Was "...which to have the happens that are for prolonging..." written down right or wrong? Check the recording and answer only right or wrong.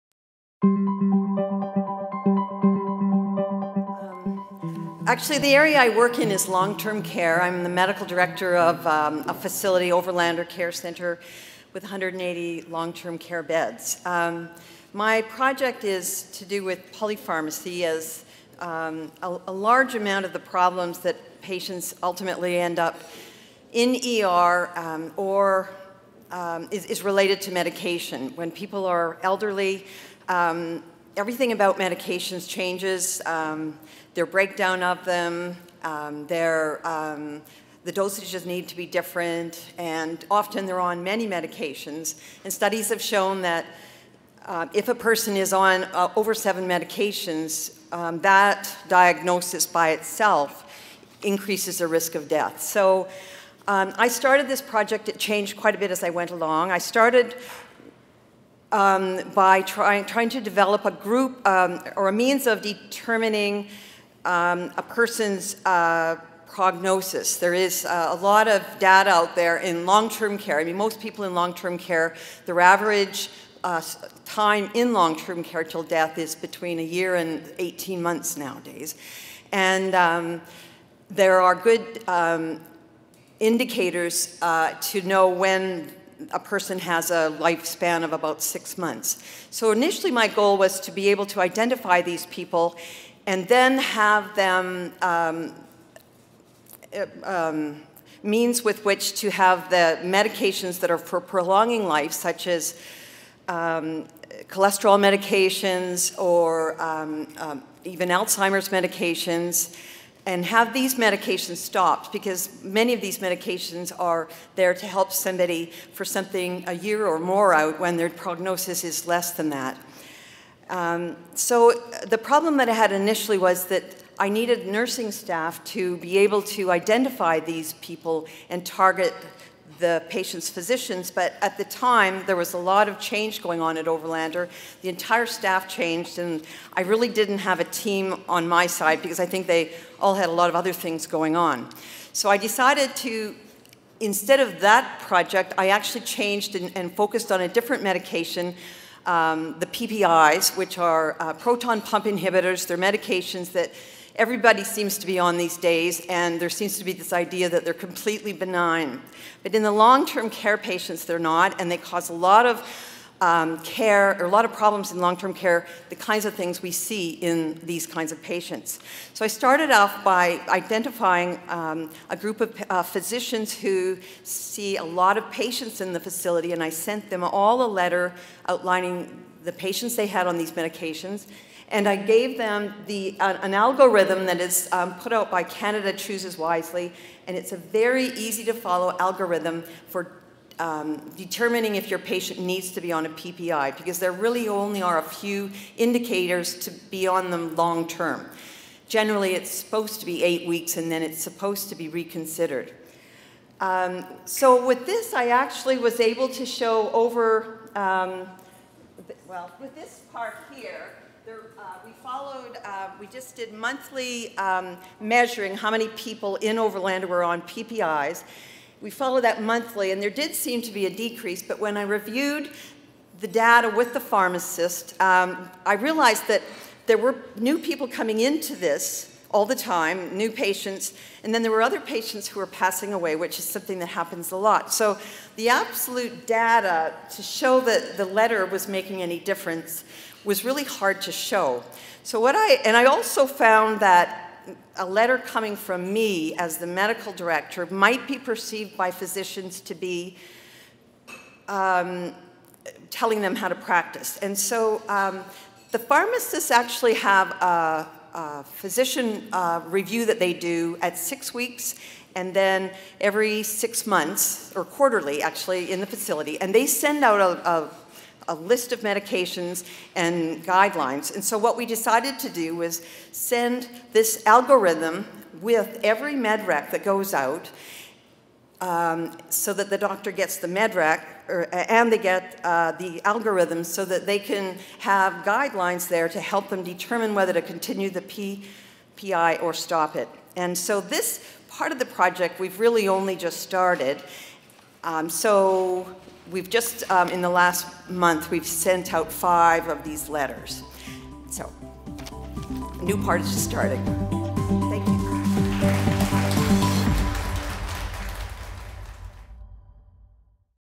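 wrong.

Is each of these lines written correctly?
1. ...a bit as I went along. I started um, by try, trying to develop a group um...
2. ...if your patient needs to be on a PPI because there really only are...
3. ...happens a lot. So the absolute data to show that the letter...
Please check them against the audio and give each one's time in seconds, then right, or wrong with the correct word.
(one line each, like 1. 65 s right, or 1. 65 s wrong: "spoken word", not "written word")
1. 55 s right
2. 191 s right
3. 233 s right.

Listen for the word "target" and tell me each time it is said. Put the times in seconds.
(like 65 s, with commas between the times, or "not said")
128 s.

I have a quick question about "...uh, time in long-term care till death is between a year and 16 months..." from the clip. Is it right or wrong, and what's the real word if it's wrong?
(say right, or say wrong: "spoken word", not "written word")
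wrong: "18", not "16".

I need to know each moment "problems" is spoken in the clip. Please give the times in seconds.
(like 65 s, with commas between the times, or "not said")
20 s, 122 s, 164 s.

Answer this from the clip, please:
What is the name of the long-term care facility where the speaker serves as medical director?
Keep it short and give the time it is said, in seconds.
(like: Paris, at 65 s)
Overlander Care Center, at 9 s.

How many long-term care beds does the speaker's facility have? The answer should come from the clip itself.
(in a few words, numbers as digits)
180.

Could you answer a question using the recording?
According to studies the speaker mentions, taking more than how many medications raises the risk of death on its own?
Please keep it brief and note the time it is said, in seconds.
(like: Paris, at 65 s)
7, at 46 s.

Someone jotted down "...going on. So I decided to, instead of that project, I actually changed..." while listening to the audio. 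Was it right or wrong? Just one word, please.
right.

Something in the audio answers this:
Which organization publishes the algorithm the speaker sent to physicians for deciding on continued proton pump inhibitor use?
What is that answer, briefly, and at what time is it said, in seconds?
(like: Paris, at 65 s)
Canada Chooses Wisely, at 185 s.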